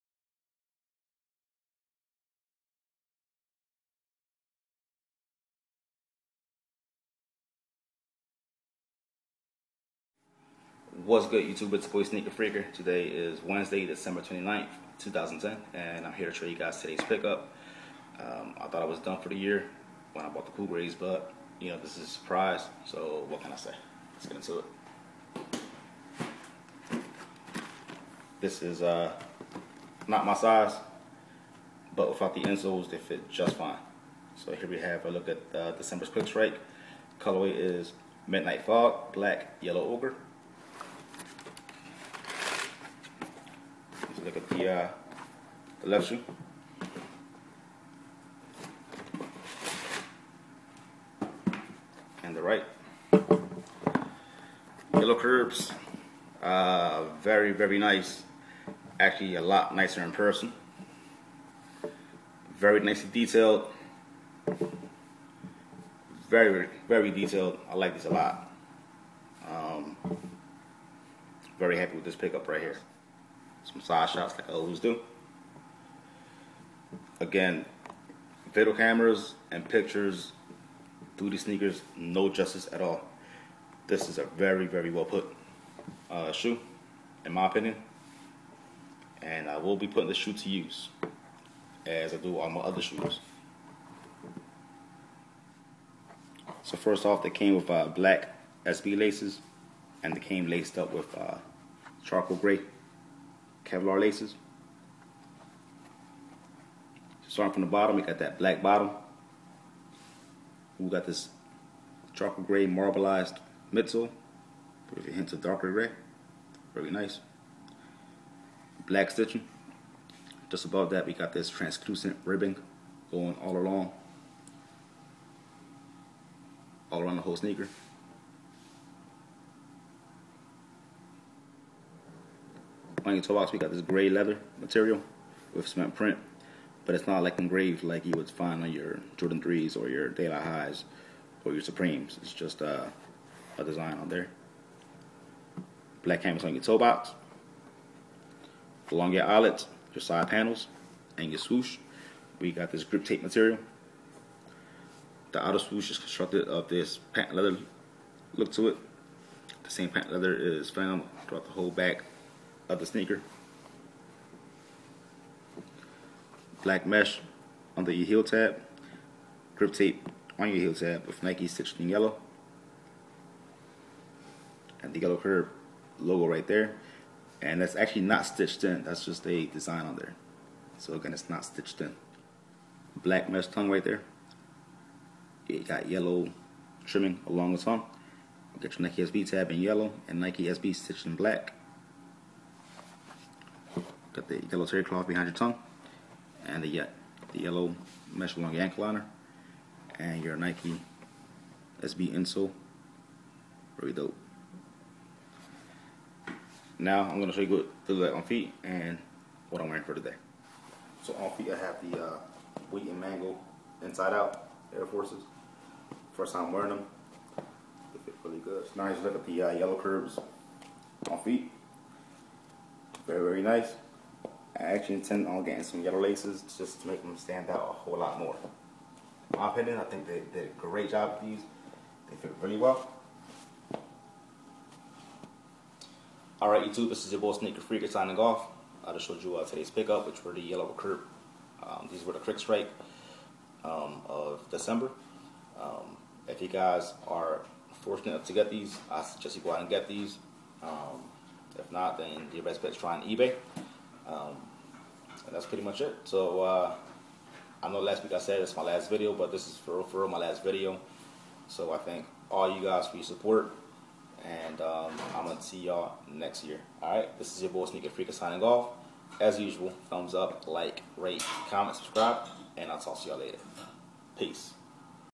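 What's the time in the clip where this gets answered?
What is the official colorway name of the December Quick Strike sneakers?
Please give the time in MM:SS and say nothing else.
00:38.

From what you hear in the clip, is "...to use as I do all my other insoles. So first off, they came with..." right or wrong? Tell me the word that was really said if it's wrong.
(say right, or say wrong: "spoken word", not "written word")
wrong: "shoes", not "insoles".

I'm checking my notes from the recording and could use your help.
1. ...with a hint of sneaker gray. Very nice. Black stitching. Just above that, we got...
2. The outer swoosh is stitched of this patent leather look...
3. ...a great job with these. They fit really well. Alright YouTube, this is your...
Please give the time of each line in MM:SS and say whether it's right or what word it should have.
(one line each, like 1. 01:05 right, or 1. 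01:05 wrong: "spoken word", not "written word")
1. 01:54 wrong: "darker", not "sneaker"
2. 02:35 wrong: "constructed", not "stitched"
3. 03:50 right.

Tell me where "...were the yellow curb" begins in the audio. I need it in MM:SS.
04:00.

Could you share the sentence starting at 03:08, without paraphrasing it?
Get your Nike SB tab in yellow and Nike SB stitched in black.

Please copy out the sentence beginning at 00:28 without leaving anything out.
This is uh, not my size, but without the insoles, they fit just fine.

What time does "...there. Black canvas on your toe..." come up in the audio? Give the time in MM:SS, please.
02:24.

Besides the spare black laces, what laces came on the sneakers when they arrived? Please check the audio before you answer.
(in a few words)
Charcoal gray Kevlar laces.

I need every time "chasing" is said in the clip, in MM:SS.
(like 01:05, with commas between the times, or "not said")
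not said.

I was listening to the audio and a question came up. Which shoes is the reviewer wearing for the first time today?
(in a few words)
Wheat and mango inside out Air Forces.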